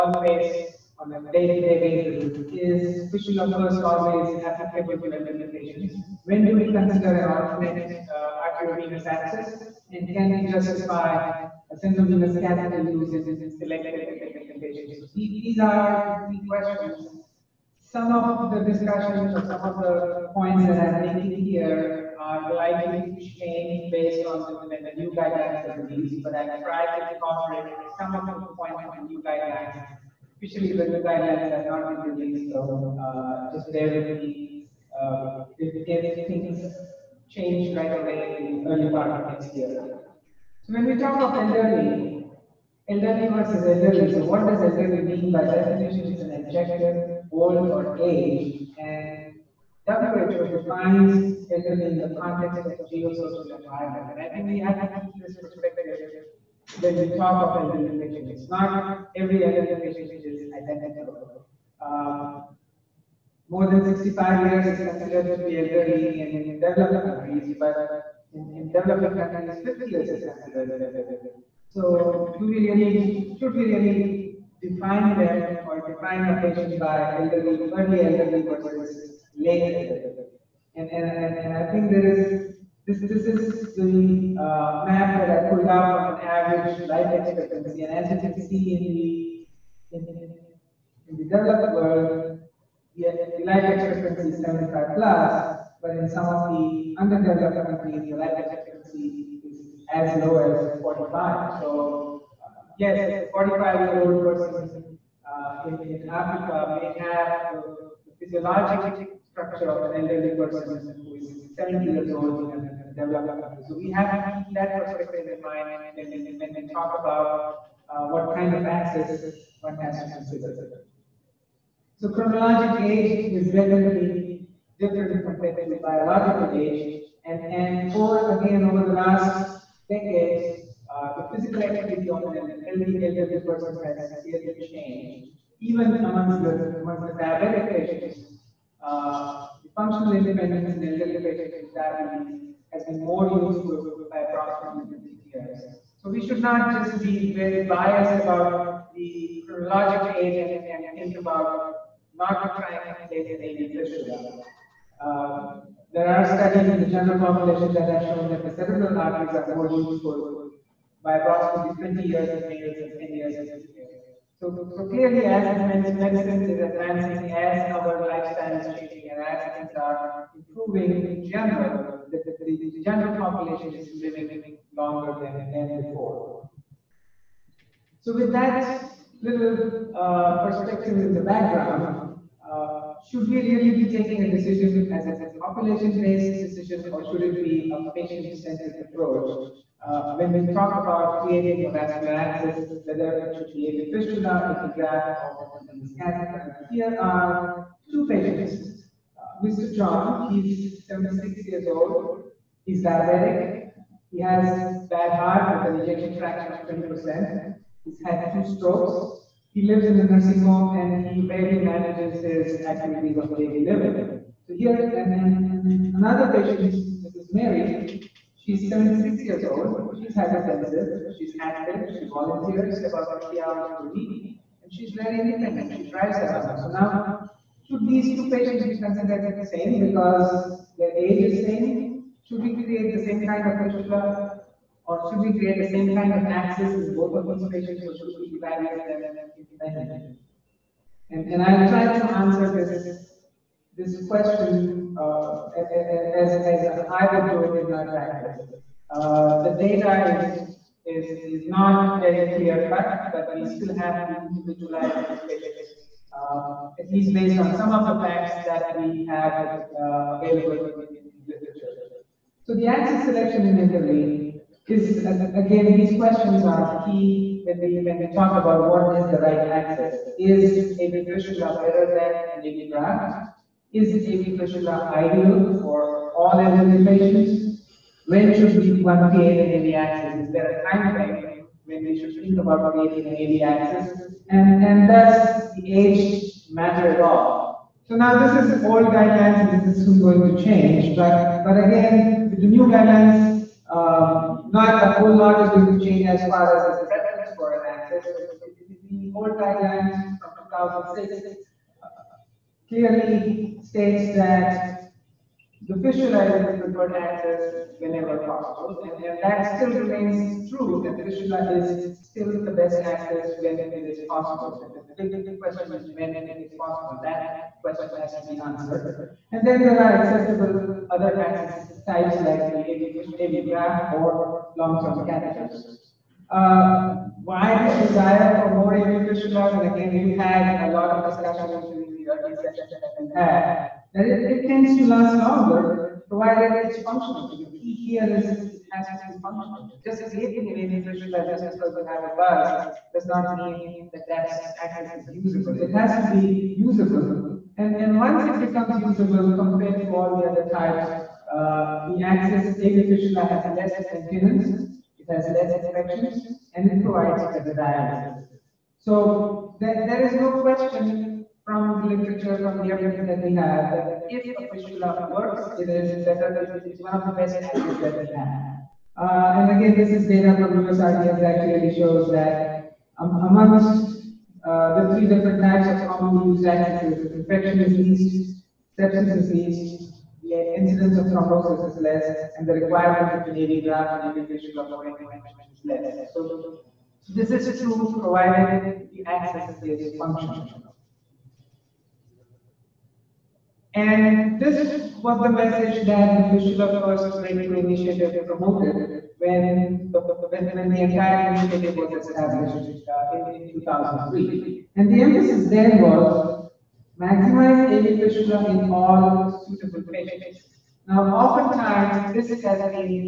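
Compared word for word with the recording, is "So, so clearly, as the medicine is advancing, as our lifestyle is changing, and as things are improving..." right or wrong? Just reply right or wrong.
right.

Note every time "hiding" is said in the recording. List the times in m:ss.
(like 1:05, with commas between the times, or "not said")
not said.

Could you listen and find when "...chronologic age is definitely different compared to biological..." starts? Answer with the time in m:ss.
2:02.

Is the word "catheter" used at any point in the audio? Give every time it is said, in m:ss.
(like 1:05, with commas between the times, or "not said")
0:12, 3:16, 5:25.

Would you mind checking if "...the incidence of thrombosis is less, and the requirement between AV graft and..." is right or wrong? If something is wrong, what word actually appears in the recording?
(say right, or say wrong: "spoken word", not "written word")
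right.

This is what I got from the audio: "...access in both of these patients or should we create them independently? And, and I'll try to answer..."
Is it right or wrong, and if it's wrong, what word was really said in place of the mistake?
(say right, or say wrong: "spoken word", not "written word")
wrong: "evaluate", not "create".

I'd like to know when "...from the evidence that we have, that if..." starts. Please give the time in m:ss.
6:02.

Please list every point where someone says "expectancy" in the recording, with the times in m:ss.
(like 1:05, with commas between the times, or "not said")
1:27, 1:33, 1:38.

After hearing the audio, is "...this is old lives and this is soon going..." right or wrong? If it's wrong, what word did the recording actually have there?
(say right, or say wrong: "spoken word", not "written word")
wrong: "guidelines", not "lives".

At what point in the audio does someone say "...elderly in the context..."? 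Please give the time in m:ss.
0:51.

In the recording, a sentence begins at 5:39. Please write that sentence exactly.
Just creating an laser fistula just because you have a buzz does not mean that that access is usable.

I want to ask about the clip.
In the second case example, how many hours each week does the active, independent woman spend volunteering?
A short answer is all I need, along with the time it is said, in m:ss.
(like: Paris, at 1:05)
50 hours, at 3:43.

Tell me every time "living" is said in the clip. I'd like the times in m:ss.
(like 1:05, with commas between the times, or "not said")
2:53, 3:33.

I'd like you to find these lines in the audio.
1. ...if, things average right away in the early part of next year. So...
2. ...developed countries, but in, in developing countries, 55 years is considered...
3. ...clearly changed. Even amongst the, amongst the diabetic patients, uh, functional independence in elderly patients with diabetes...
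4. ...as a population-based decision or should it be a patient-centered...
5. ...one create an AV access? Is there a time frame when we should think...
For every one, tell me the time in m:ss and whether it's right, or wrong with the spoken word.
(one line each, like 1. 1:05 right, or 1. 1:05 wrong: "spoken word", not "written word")
1. 0:35 wrong: "change", not "average"
2. 1:06 wrong: "50", not "55"
3. 2:14 right
4. 3:04 right
5. 4:38 right.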